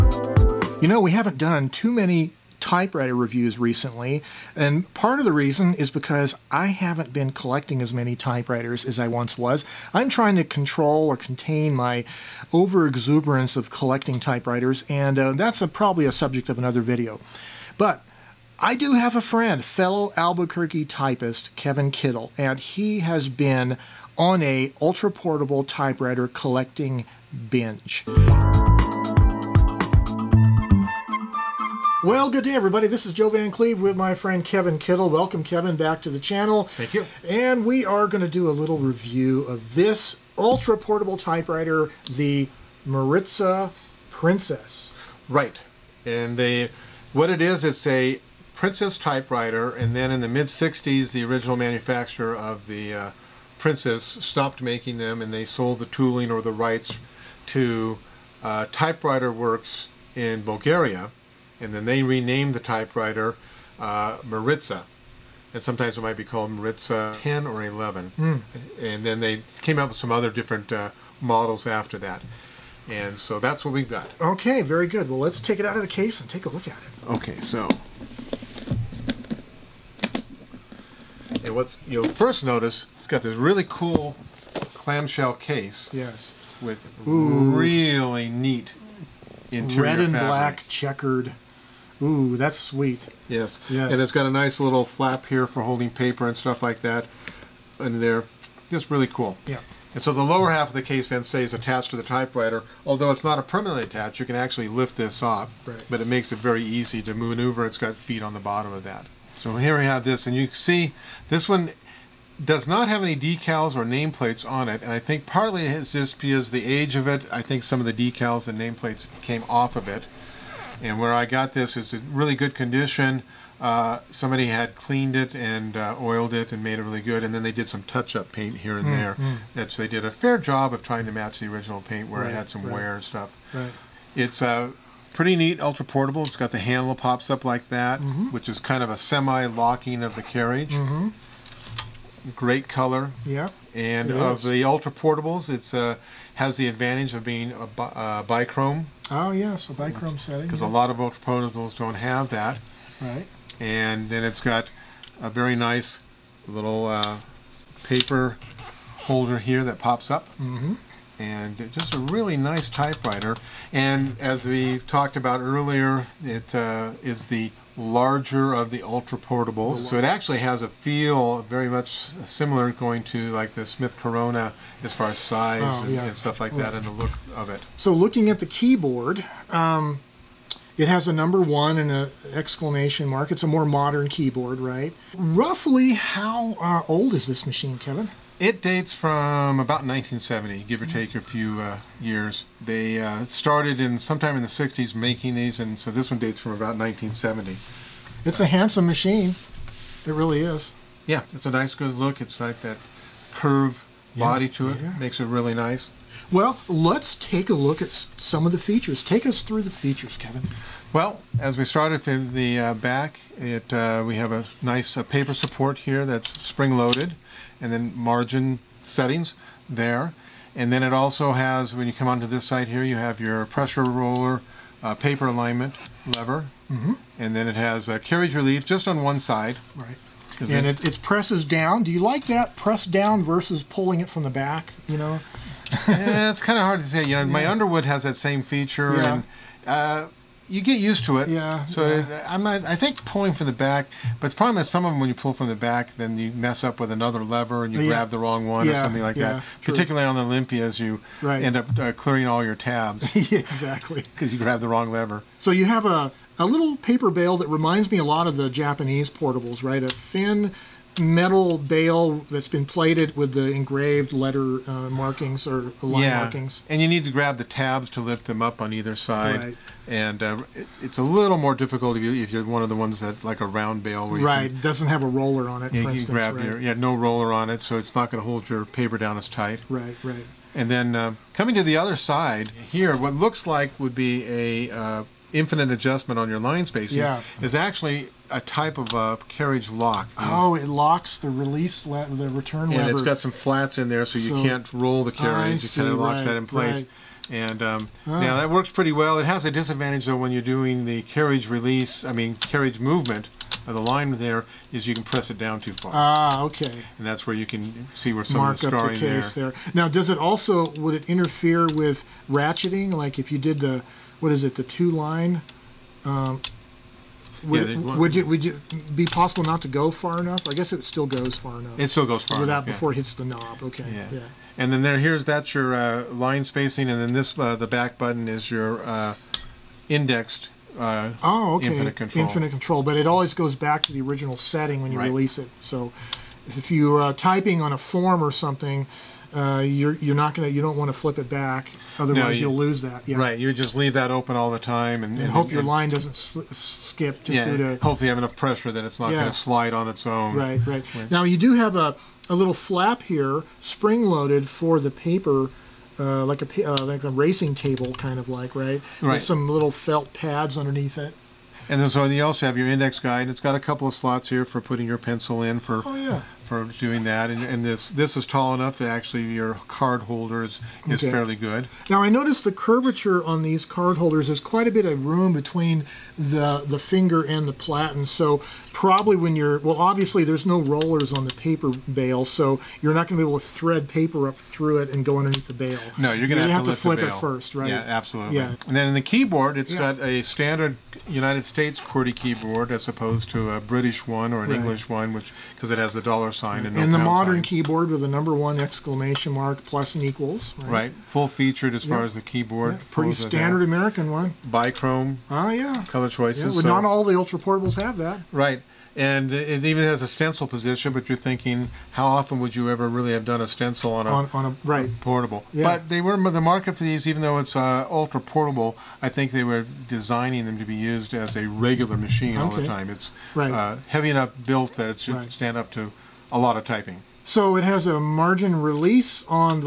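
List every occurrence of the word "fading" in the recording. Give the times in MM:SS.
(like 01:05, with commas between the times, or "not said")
not said.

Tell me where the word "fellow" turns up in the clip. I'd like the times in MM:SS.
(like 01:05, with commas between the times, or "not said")
00:19.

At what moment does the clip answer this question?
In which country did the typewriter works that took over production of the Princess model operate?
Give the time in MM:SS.
01:00.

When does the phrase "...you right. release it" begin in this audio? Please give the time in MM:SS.
05:34.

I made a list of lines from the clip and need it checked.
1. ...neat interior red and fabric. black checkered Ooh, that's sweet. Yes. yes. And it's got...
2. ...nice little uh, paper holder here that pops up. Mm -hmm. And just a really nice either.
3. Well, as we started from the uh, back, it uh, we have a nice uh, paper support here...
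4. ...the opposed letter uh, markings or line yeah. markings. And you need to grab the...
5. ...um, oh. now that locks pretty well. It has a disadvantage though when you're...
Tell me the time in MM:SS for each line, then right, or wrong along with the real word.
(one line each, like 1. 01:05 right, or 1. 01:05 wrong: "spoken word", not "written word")
1. 01:28 right
2. 02:35 wrong: "typewriter", not "either"
3. 03:30 right
4. 04:23 wrong: "engraved", not "opposed"
5. 04:57 wrong: "works", not "locks".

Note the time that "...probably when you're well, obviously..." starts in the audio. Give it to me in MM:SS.
06:18.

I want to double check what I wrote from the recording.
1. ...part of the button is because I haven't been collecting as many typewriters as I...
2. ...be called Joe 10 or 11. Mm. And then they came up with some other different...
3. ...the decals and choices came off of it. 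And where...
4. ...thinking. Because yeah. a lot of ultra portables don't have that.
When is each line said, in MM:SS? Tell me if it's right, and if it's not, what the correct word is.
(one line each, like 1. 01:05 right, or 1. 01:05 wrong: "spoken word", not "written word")
1. 00:04 wrong: "reason", not "button"
2. 01:06 wrong: "Maritsa", not "Joe"
3. 01:57 wrong: "nameplates", not "choices"
4. 02:30 wrong: "setting", not "thinking".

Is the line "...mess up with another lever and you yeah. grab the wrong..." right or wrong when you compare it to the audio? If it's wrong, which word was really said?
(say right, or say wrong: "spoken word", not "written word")
right.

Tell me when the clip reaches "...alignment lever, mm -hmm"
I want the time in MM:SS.
03:45.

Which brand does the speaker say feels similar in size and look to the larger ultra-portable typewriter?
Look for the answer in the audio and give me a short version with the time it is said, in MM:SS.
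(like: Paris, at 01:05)
Smith Corona, at 02:53.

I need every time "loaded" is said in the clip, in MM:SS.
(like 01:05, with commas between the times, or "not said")
03:36, 05:54.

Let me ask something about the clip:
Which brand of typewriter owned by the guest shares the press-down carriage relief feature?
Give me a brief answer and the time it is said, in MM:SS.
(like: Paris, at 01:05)
Underwood, at 03:57.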